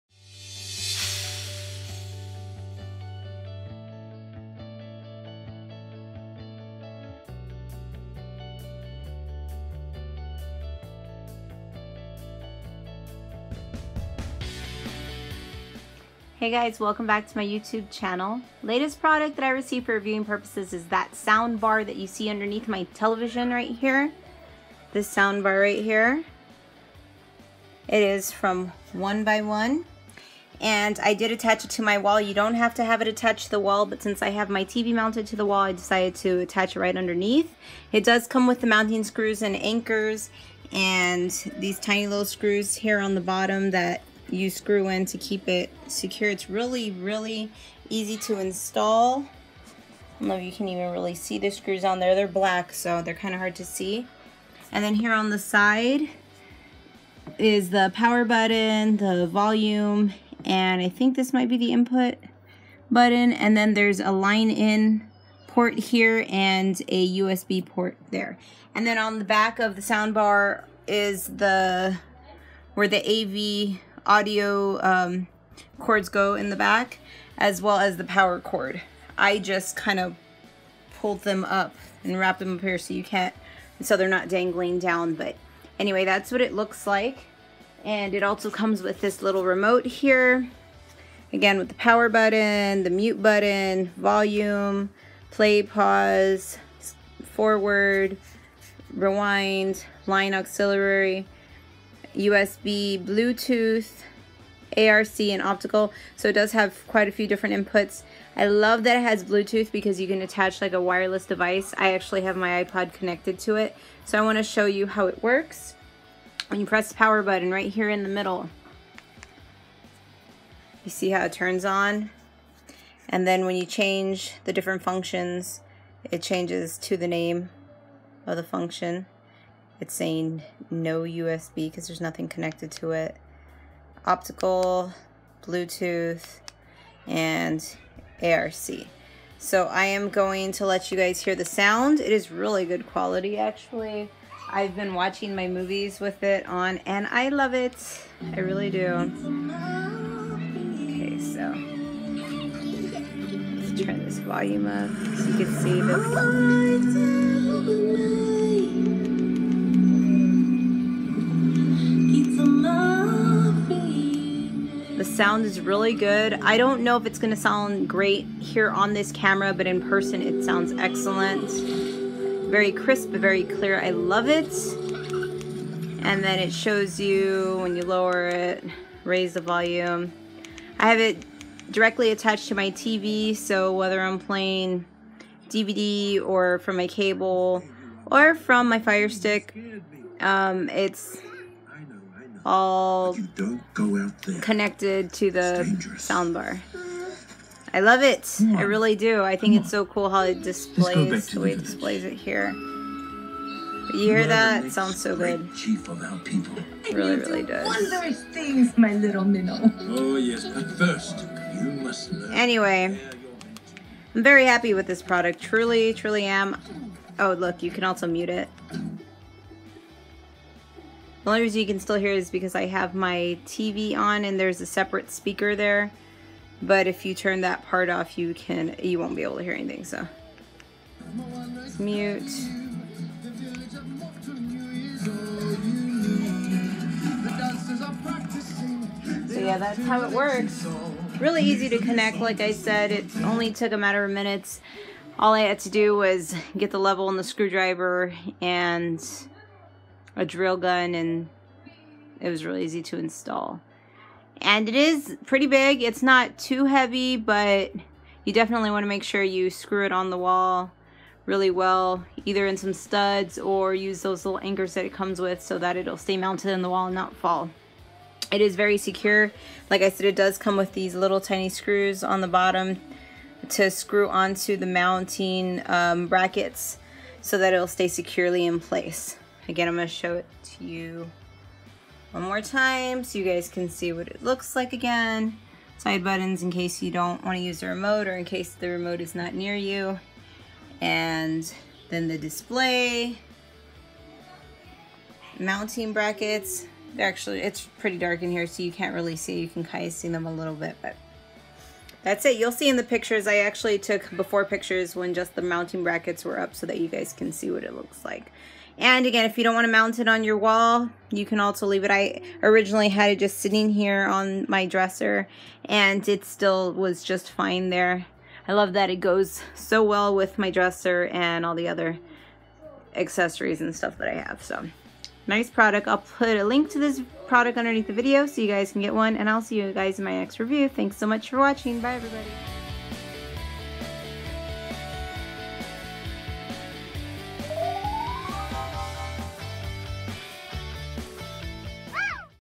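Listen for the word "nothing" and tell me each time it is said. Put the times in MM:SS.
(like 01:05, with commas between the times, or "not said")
02:11.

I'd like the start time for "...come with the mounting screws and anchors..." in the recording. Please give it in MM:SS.
00:38.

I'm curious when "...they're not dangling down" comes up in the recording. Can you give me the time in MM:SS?
01:23.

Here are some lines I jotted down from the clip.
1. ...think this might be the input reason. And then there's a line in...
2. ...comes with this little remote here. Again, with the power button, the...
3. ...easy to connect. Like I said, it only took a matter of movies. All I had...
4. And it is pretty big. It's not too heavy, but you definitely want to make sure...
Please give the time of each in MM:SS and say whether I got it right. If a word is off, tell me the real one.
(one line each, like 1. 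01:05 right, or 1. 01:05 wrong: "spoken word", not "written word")
1. 01:00 wrong: "button", not "reason"
2. 01:28 right
3. 04:01 wrong: "minutes", not "movies"
4. 04:14 right.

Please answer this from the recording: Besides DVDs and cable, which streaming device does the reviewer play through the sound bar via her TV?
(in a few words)
Fire Stick.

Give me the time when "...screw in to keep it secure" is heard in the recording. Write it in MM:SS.
00:44.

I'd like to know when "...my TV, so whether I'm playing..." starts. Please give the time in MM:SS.
03:02.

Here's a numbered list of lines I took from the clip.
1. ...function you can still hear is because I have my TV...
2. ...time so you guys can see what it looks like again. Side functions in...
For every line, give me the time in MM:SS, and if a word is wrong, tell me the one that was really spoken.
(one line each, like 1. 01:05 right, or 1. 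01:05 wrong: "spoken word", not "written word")
1. 03:41 wrong: "reason", not "function"
2. 04:42 wrong: "buttons", not "functions".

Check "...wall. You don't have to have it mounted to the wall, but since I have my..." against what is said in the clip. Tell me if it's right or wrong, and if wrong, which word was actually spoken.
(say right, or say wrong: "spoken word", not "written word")
wrong: "attached", not "mounted".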